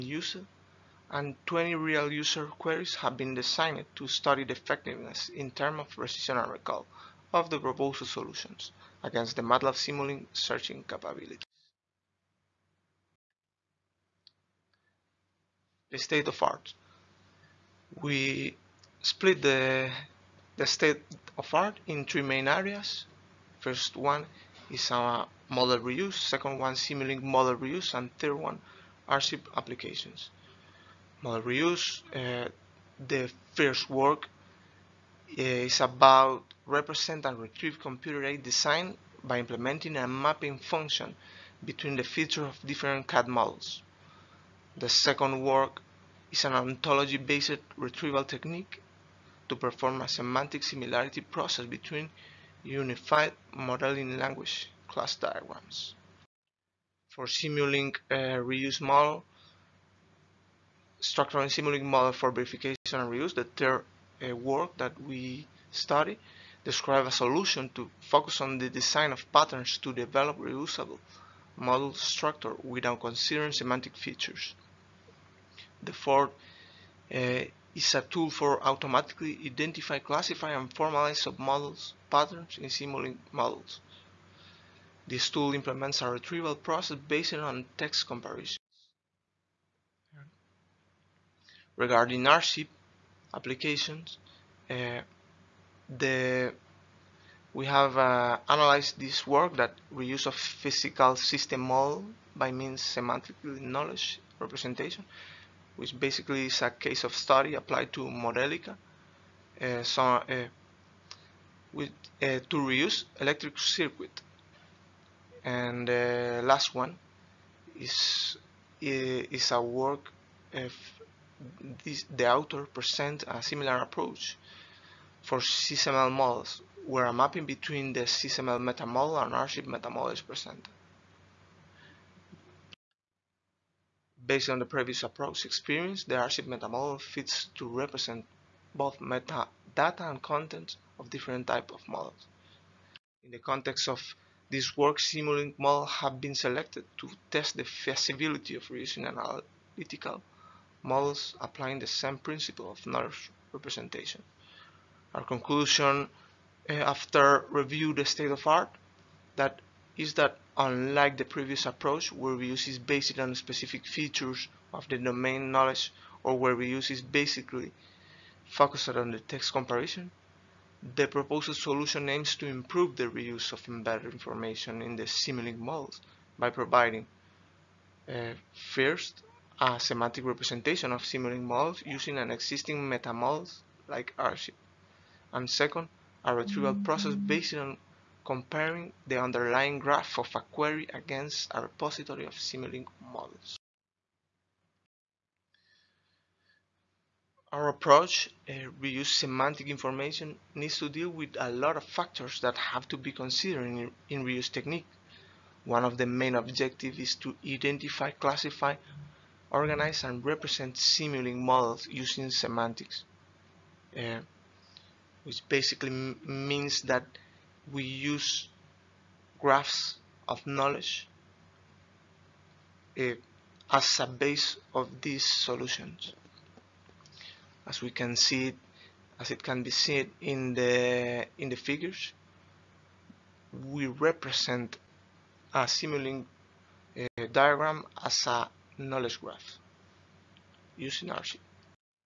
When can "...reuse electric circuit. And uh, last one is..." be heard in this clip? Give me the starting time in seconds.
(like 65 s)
112 s.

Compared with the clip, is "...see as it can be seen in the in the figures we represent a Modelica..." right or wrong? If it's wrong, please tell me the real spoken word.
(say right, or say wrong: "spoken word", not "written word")
wrong: "Simulink", not "Modelica".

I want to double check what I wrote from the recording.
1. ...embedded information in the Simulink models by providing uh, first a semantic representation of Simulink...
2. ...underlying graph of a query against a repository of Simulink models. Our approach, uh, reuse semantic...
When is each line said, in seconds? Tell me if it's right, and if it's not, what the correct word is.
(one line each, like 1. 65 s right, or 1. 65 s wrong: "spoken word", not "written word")
1. 173 s right
2. 189 s right.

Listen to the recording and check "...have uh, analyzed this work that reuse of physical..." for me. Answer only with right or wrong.
right.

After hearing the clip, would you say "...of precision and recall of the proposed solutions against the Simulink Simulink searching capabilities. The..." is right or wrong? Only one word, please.
wrong.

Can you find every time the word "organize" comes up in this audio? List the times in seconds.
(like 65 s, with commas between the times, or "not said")
209 s.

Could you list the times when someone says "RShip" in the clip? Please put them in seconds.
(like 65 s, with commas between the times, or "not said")
129 s, 184 s.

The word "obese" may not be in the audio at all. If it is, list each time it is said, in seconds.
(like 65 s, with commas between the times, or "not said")
not said.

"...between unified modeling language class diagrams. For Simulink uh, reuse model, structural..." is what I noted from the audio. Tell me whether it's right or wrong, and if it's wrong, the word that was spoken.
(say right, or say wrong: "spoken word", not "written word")
right.